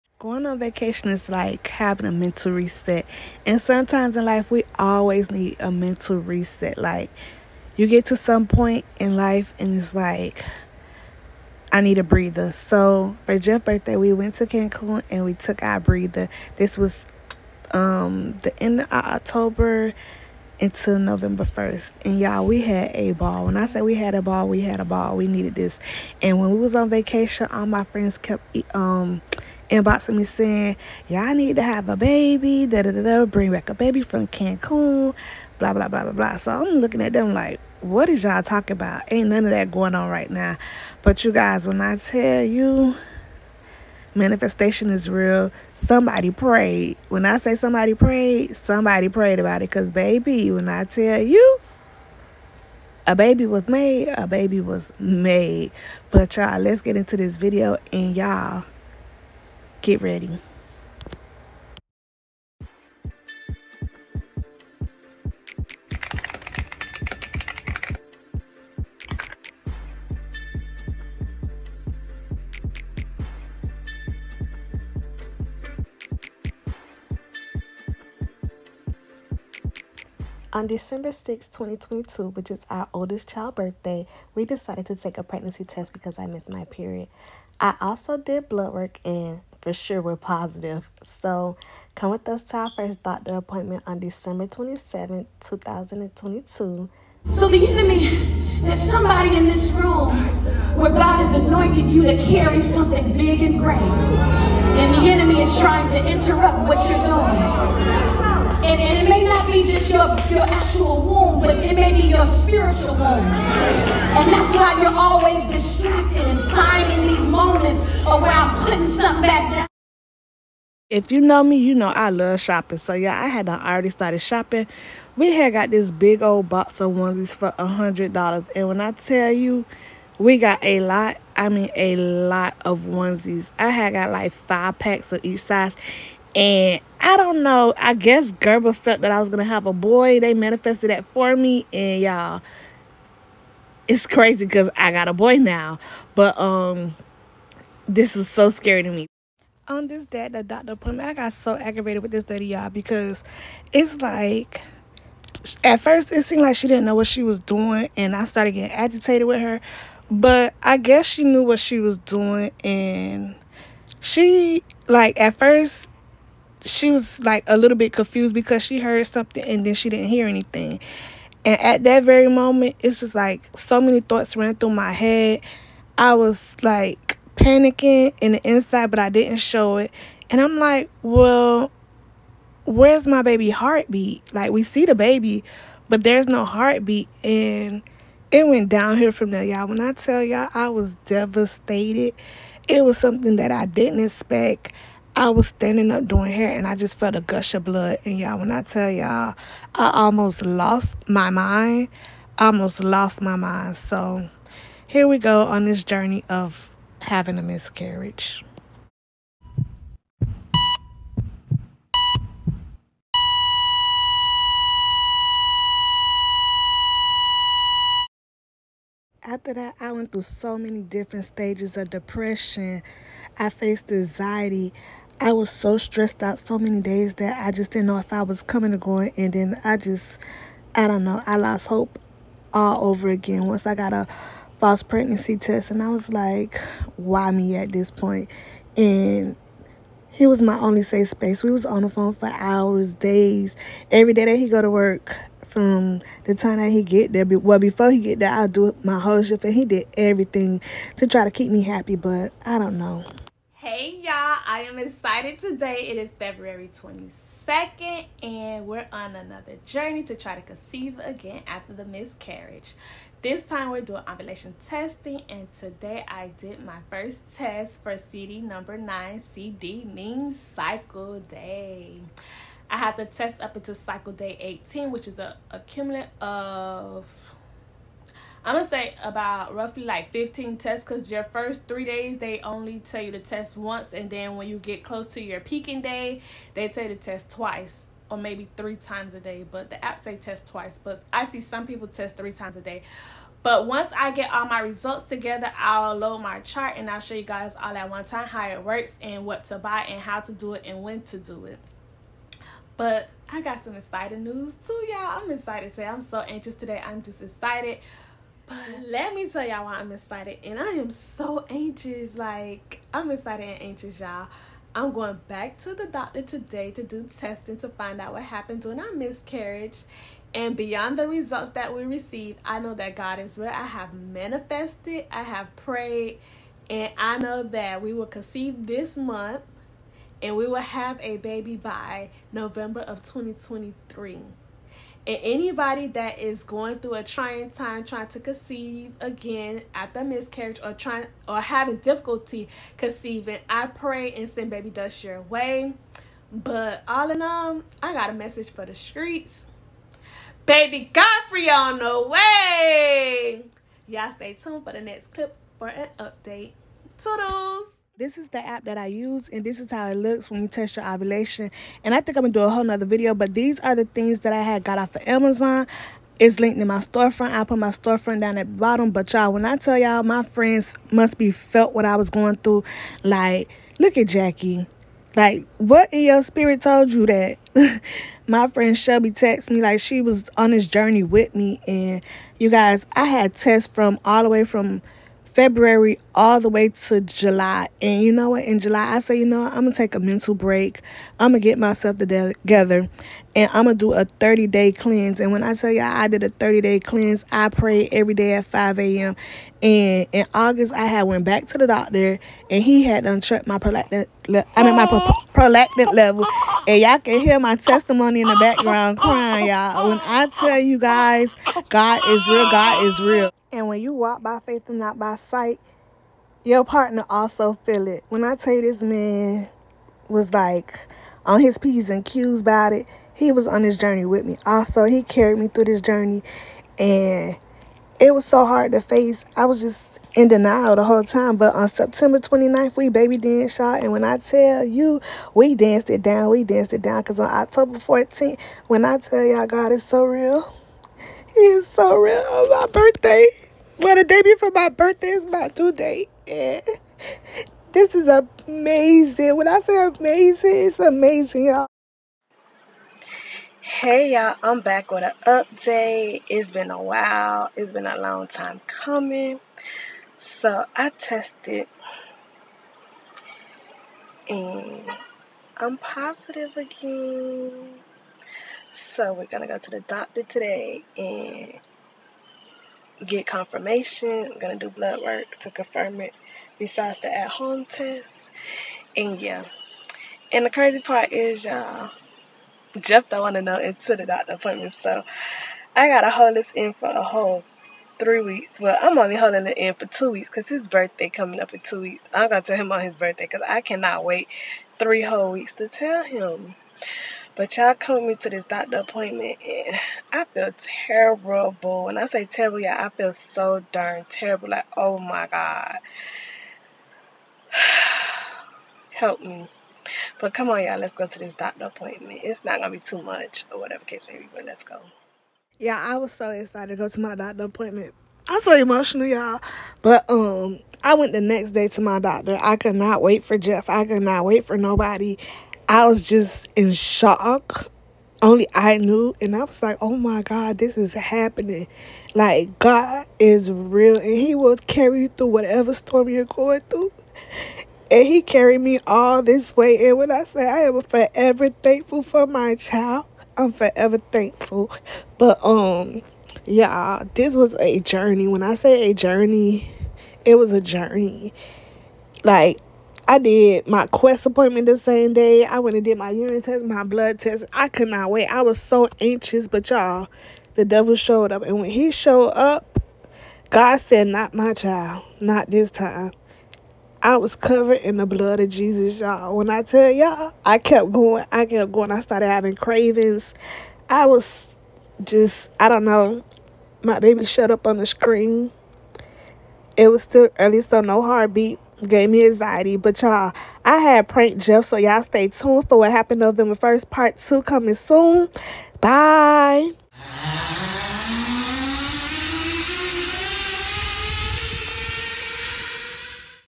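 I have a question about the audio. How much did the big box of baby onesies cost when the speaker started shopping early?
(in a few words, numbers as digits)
$100.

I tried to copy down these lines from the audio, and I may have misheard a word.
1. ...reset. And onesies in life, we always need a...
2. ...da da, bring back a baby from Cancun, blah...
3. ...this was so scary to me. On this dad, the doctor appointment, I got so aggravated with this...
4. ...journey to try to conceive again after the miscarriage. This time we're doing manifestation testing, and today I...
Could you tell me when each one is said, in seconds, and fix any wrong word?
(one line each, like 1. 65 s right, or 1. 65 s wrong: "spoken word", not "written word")
1. 2 s wrong: "sometimes", not "onesies"
2. 32 s right
3. 147 s right
4. 259 s wrong: "ovulation", not "manifestation".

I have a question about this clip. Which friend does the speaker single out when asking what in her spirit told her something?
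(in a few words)
Jackie.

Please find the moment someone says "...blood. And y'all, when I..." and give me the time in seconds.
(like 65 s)
197 s.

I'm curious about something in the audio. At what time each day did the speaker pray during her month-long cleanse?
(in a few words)
5 a.m.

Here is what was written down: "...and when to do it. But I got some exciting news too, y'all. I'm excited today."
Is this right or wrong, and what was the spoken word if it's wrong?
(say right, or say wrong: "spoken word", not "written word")
right.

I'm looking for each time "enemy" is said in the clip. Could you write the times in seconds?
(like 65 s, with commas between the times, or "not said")
97 s, 105 s.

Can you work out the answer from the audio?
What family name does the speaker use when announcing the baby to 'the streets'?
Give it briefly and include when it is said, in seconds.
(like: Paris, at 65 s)
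Godfrey, at 350 s.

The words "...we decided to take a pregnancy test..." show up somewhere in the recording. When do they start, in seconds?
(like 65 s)
84 s.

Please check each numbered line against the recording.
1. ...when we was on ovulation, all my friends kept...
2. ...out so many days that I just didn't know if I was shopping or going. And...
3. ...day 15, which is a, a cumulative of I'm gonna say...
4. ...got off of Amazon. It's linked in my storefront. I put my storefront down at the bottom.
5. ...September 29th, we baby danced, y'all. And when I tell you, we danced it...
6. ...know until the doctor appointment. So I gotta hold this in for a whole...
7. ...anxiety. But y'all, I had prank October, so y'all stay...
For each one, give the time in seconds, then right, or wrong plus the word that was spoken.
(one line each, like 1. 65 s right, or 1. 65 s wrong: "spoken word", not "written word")
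1. 26 s wrong: "vacation", not "ovulation"
2. 226 s wrong: "coming", not "shopping"
3. 274 s wrong: "18", not "15"
4. 364 s right
5. 431 s right
6. 483 s right
7. 582 s wrong: "Jeff", not "October".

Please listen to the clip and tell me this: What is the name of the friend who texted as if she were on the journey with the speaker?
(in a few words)
Shelby.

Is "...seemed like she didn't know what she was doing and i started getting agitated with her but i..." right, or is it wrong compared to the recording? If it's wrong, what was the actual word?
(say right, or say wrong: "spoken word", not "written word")
right.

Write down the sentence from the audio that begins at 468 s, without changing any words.
So we're gonna go to the doctor today and get confirmation.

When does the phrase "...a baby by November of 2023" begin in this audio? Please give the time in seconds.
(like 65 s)
331 s.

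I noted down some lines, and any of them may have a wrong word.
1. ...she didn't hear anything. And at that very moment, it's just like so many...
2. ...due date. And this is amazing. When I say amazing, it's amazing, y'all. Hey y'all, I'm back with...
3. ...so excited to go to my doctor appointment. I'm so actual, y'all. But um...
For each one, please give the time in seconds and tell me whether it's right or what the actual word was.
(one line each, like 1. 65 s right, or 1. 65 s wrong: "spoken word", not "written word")
1. 169 s right
2. 445 s right
3. 516 s wrong: "emotional", not "actual".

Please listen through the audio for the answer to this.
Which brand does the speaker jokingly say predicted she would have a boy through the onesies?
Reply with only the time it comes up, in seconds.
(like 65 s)
138 s.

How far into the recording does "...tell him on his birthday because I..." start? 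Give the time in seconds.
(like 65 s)
492 s.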